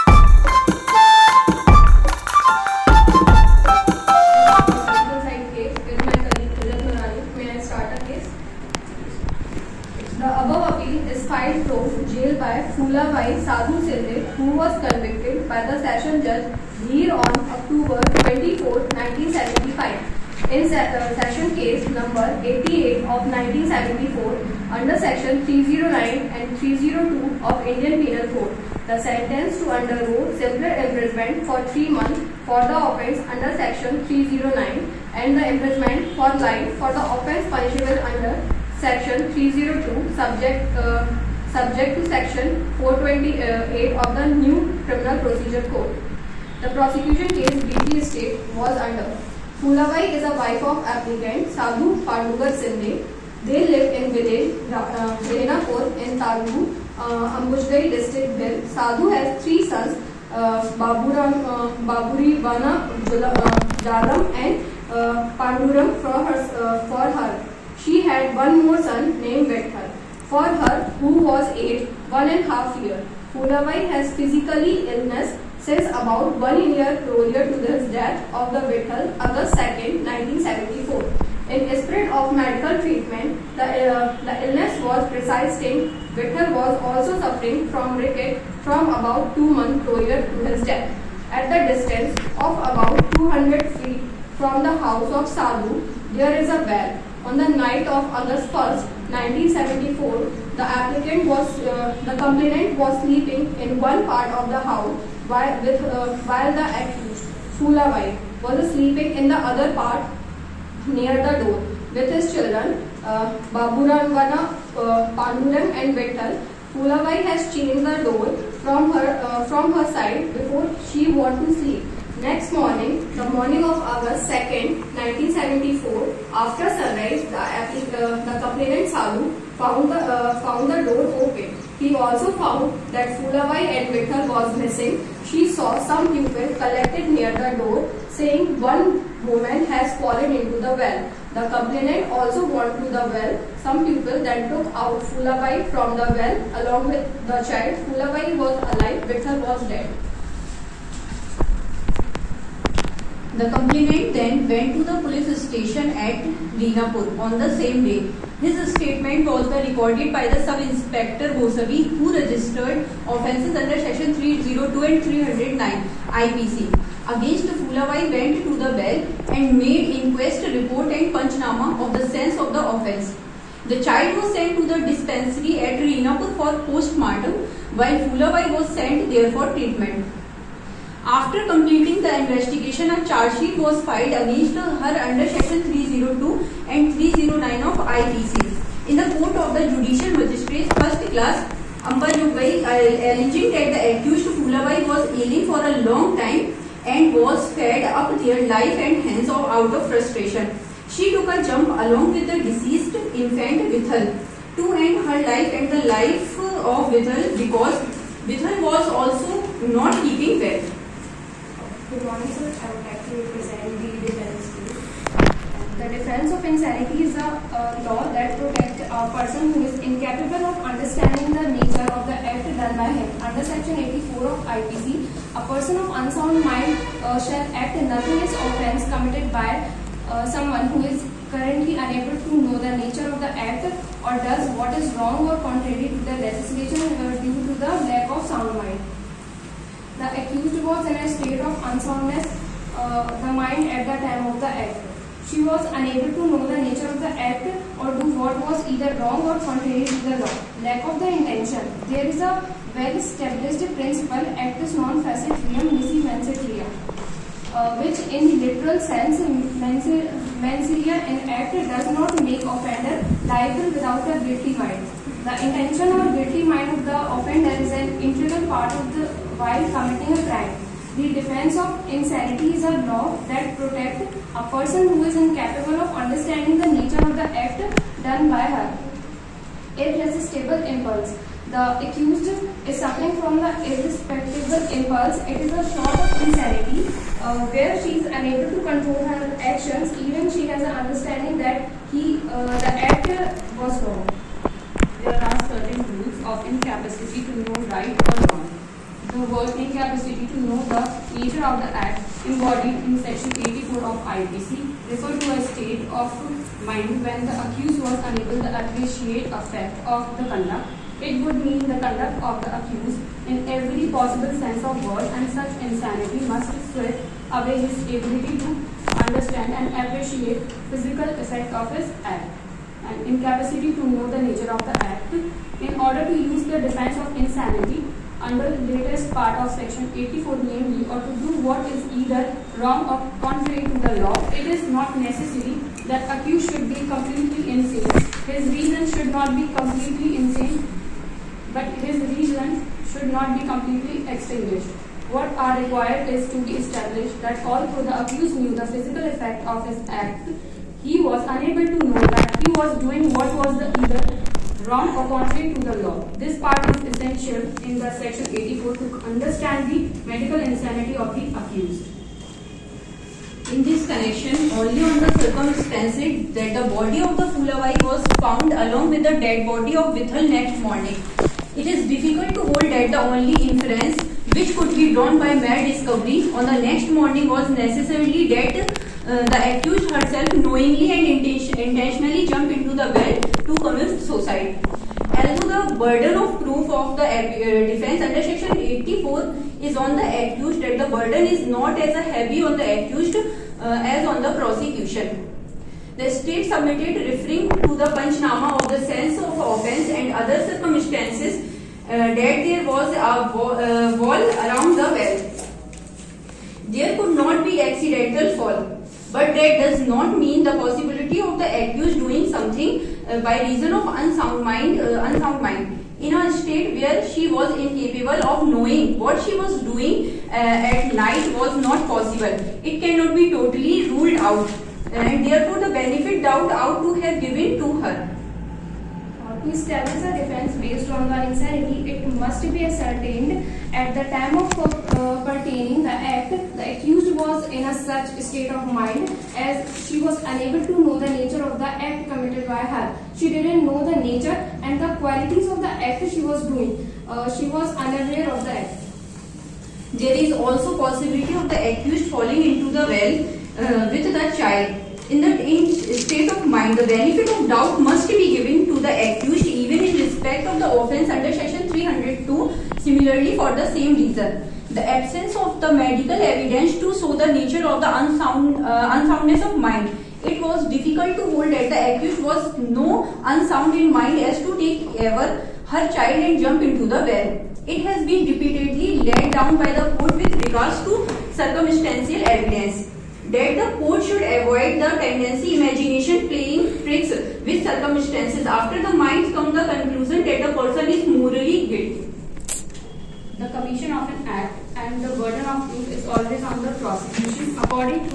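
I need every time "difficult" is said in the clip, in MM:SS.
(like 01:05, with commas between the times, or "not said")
06:11, 07:50.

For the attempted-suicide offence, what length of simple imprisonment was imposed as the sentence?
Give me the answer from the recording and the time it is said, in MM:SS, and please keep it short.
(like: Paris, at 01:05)
3 months, at 00:31.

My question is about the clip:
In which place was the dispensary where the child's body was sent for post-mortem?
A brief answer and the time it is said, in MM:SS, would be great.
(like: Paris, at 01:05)
Rinapur, at 02:55.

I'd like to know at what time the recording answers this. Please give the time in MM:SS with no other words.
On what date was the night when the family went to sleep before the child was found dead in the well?
01:38.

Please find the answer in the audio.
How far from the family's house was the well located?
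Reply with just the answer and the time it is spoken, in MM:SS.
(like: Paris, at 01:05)
200 feet, at 01:33.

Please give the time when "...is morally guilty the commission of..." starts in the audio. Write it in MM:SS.
08:10.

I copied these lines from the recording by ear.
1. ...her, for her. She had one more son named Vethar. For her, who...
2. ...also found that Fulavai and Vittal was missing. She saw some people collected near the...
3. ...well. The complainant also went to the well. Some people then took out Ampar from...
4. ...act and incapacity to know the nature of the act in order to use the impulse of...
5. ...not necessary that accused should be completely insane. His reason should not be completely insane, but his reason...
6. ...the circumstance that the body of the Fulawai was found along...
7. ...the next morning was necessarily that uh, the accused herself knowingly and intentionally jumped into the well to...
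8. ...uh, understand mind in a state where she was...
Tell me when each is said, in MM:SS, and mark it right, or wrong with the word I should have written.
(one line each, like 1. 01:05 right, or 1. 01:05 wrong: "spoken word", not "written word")
1. 01:06 right
2. 02:11 right
3. 02:20 wrong: "Fulabai", not "Ampar"
4. 05:22 wrong: "defense", not "impulse"
5. 05:34 right
6. 06:04 right
7. 06:16 right
8. 06:54 wrong: "unsound", not "understand".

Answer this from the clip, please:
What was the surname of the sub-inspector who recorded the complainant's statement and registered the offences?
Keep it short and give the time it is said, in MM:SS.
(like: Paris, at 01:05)
Gosavi, at 02:41.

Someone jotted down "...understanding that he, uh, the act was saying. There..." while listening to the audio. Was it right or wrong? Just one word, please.
wrong.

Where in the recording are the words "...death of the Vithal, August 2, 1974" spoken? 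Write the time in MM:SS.
01:17.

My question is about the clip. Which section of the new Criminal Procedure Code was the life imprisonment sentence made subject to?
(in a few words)
Section 428.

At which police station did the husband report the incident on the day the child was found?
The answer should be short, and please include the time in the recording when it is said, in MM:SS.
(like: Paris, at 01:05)
Dinapur, at 02:36.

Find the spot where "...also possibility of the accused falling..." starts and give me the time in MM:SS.
07:30.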